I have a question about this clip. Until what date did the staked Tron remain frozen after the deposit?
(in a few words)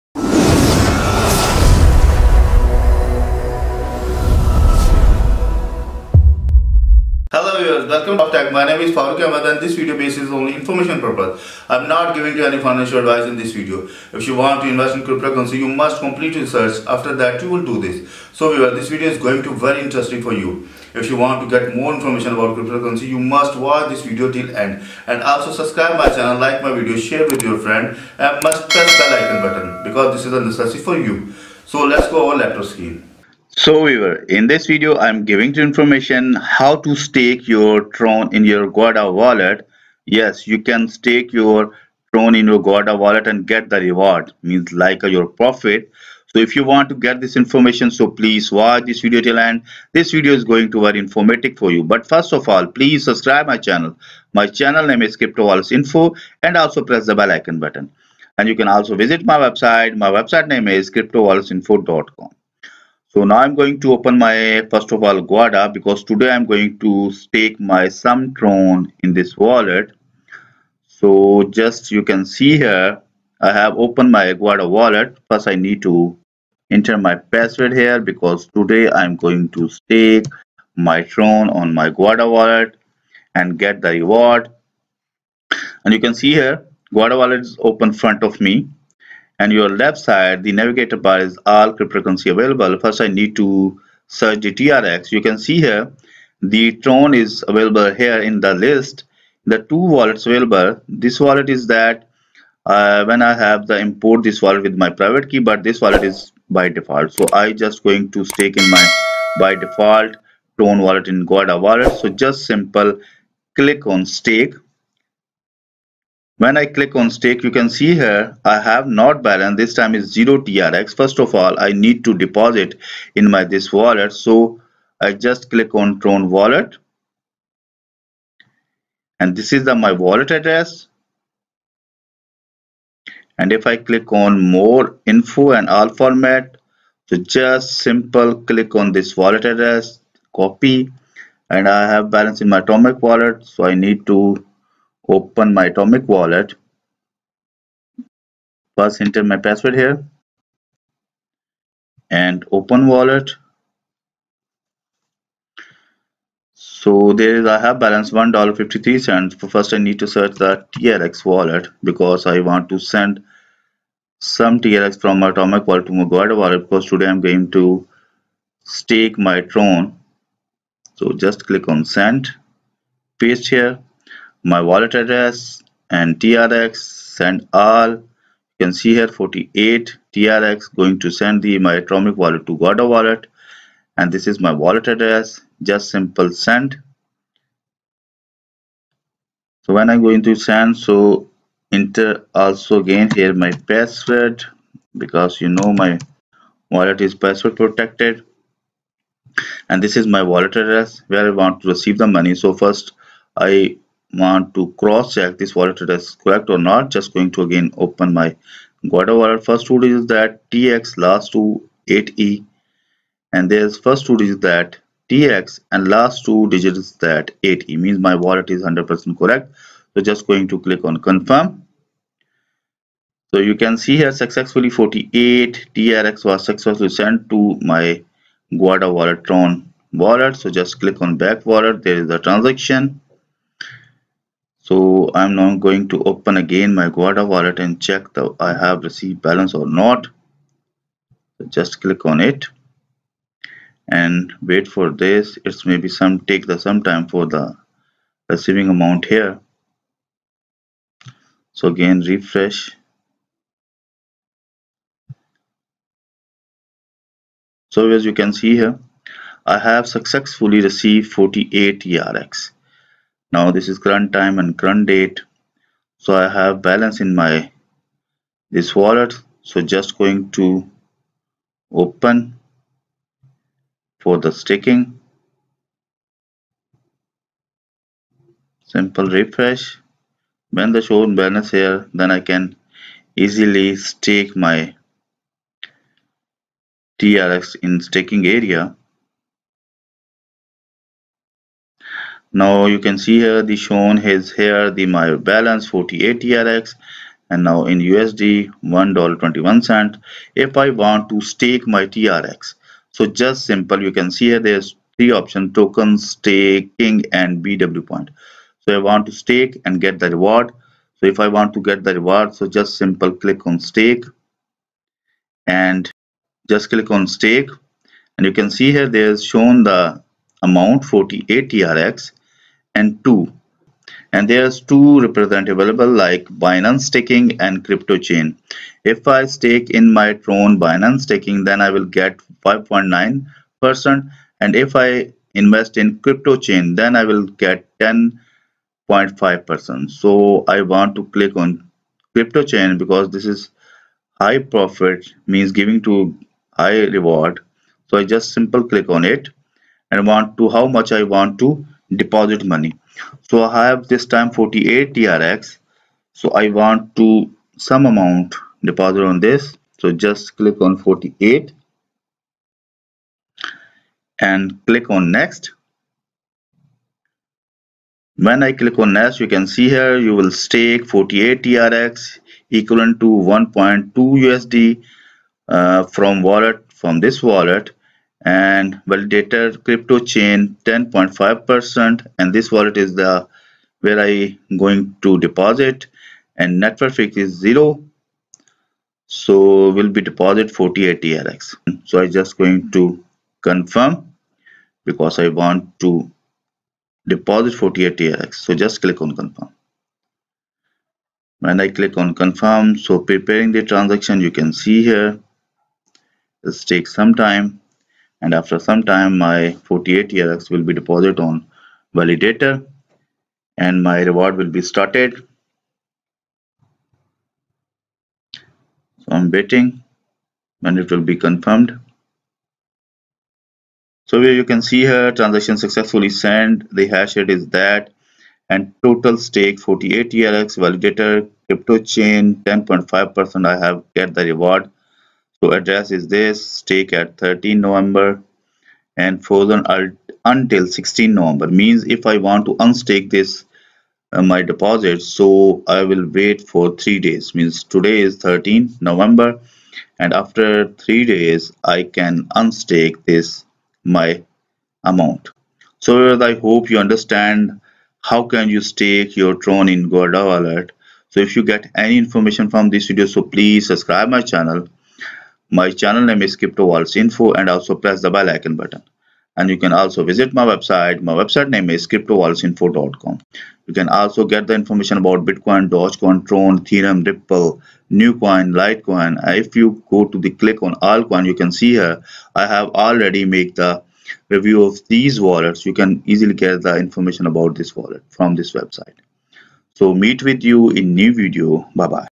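16 November.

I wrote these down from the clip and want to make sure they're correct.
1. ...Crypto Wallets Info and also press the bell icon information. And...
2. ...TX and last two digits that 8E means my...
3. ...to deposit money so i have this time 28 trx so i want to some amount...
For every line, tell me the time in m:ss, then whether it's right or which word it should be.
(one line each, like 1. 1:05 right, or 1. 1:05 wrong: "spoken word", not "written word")
1. 0:55 wrong: "button", not "information"
2. 3:35 right
3. 5:51 wrong: "48", not "28".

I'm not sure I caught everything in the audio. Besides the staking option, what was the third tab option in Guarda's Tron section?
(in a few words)
BW point.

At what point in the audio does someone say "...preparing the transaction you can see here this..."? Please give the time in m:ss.
6:42.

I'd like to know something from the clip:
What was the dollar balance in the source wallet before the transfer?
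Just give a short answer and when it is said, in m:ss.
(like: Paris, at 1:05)
$1.53, at 2:38.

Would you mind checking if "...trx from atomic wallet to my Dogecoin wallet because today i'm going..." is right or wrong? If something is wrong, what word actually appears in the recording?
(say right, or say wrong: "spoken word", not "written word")
wrong: "Guarda", not "Dogecoin".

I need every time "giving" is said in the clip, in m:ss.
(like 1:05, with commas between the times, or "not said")
0:12, 0:35, 5:45.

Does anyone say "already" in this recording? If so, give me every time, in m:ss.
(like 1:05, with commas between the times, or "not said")
8:02.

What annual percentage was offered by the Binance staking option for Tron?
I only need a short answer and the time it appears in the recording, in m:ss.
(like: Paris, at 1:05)
5.9 percent, at 5:32.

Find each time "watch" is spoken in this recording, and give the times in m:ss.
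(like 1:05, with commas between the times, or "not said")
0:23, 0:48.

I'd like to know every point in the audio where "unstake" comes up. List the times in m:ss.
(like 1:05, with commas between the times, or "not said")
7:22, 7:32.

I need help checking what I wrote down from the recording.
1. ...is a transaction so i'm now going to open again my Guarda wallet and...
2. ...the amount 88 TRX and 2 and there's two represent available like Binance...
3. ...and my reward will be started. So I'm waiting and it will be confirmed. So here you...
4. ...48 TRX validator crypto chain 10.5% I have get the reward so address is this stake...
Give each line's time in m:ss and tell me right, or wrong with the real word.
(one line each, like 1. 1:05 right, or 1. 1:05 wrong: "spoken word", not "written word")
1. 3:52 right
2. 5:19 wrong: "48", not "88"
3. 6:53 right
4. 7:09 right.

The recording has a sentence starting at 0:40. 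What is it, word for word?
Yes, you can stake your Tron in your Guarda wallet and get the reward, means like your profit.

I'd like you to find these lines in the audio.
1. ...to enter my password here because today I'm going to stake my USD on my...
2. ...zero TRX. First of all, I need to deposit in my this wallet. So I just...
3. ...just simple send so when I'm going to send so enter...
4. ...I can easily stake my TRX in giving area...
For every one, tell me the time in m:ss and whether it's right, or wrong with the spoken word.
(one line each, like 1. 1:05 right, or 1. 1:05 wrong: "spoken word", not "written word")
1. 1:15 wrong: "Tron", not "USD"
2. 2:00 right
3. 3:05 right
4. 4:42 wrong: "staking", not "giving".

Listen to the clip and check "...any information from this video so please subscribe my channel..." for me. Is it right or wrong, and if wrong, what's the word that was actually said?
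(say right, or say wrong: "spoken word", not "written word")
right.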